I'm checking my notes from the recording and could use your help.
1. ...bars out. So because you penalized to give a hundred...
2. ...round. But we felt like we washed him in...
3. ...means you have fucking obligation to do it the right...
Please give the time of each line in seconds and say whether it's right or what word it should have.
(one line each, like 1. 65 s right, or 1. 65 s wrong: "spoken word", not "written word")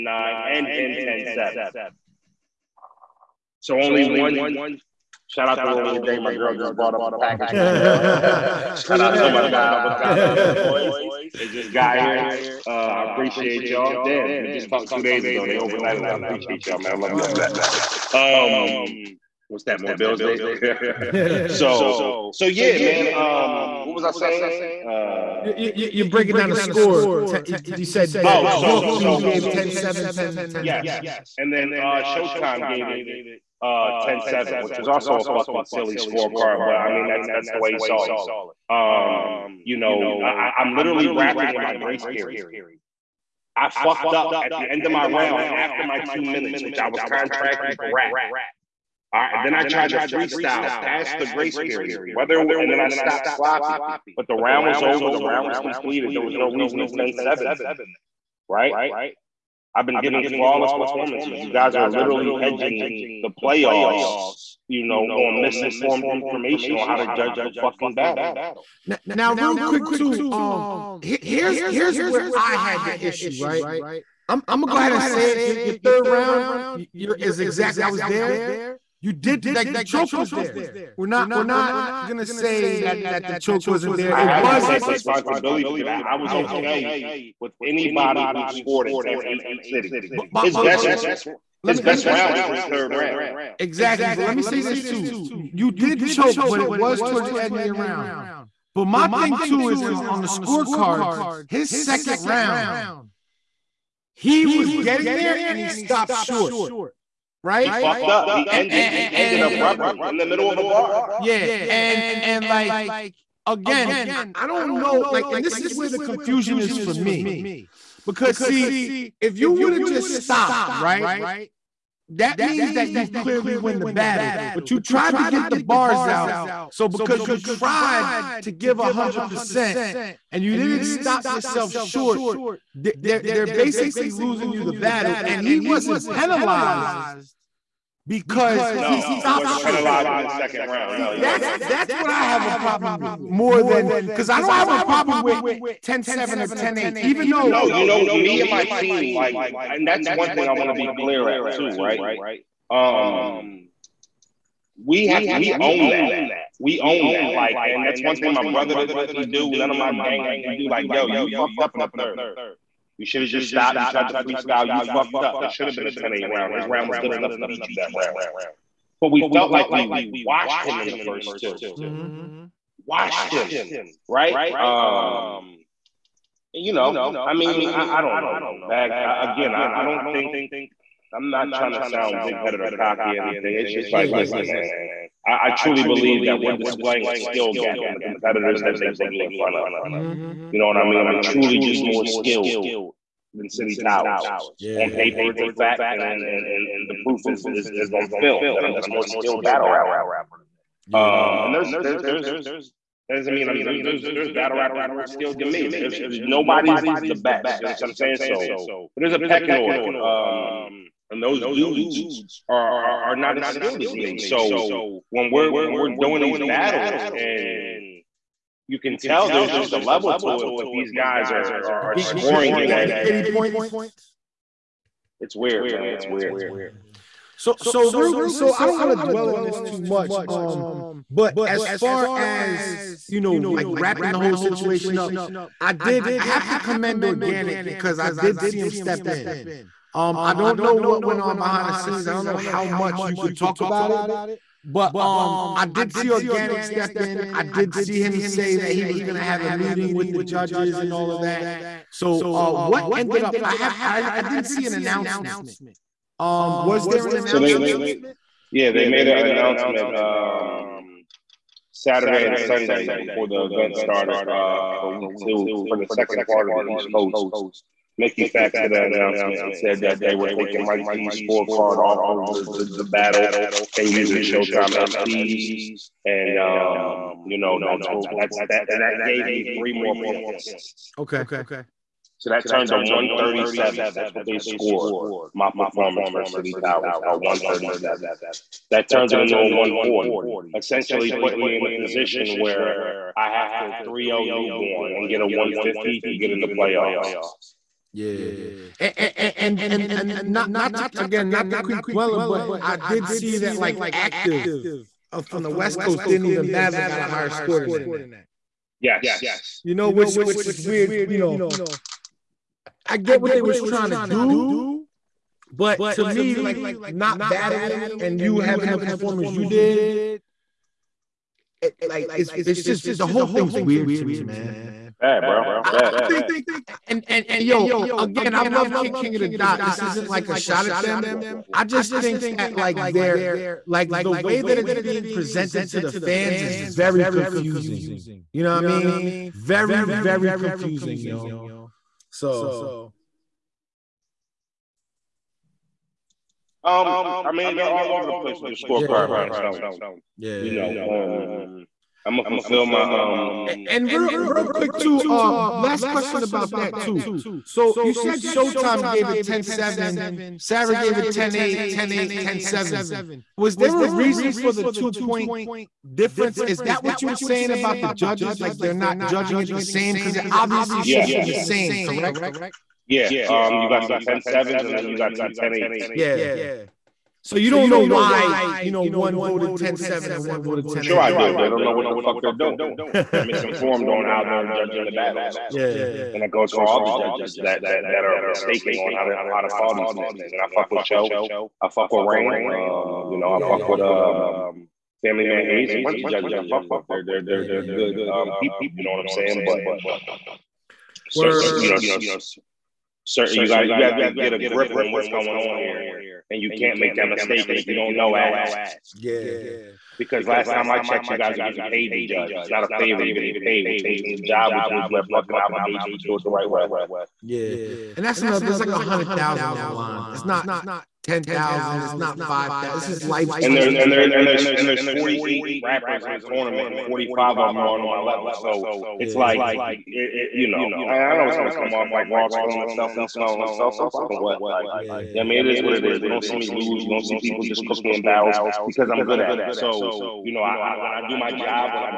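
1. 125 s wrong: "tried", not "penalized"
2. 167 s right
3. 414 s right.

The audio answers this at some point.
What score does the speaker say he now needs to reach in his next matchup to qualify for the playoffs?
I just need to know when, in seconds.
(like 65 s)
295 s.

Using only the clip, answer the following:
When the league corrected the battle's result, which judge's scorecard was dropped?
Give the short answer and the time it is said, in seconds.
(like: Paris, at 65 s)
Mike G, at 270 s.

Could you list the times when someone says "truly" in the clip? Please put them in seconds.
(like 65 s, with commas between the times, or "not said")
185 s, 191 s.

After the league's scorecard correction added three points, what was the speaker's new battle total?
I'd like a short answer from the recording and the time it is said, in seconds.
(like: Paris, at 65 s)
140, at 289 s.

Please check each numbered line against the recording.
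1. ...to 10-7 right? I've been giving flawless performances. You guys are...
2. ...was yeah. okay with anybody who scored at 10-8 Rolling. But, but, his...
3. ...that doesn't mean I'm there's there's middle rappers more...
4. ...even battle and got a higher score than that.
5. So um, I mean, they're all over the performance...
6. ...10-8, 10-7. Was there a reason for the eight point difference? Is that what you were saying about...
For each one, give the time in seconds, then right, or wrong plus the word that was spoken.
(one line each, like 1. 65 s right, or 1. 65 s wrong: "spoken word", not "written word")
1. 56 s right
2. 86 s wrong: "City", not "Rolling"
3. 203 s wrong: "battle", not "middle"
4. 306 s right
5. 342 s wrong: "place", not "performance"
6. 361 s wrong: "two", not "eight".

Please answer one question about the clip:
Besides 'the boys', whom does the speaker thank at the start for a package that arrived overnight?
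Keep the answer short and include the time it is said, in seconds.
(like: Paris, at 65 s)
Avocado, at 9 s.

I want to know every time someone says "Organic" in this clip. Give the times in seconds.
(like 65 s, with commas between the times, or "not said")
237 s, 246 s.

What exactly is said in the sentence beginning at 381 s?
They don't know what the fuck they're doing.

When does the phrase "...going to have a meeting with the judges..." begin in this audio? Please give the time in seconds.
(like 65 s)
249 s.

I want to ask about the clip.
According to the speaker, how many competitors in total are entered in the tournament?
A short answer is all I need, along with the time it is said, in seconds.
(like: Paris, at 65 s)
48, at 424 s.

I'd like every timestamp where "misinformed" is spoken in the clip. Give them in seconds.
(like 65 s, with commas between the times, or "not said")
65 s, 383 s.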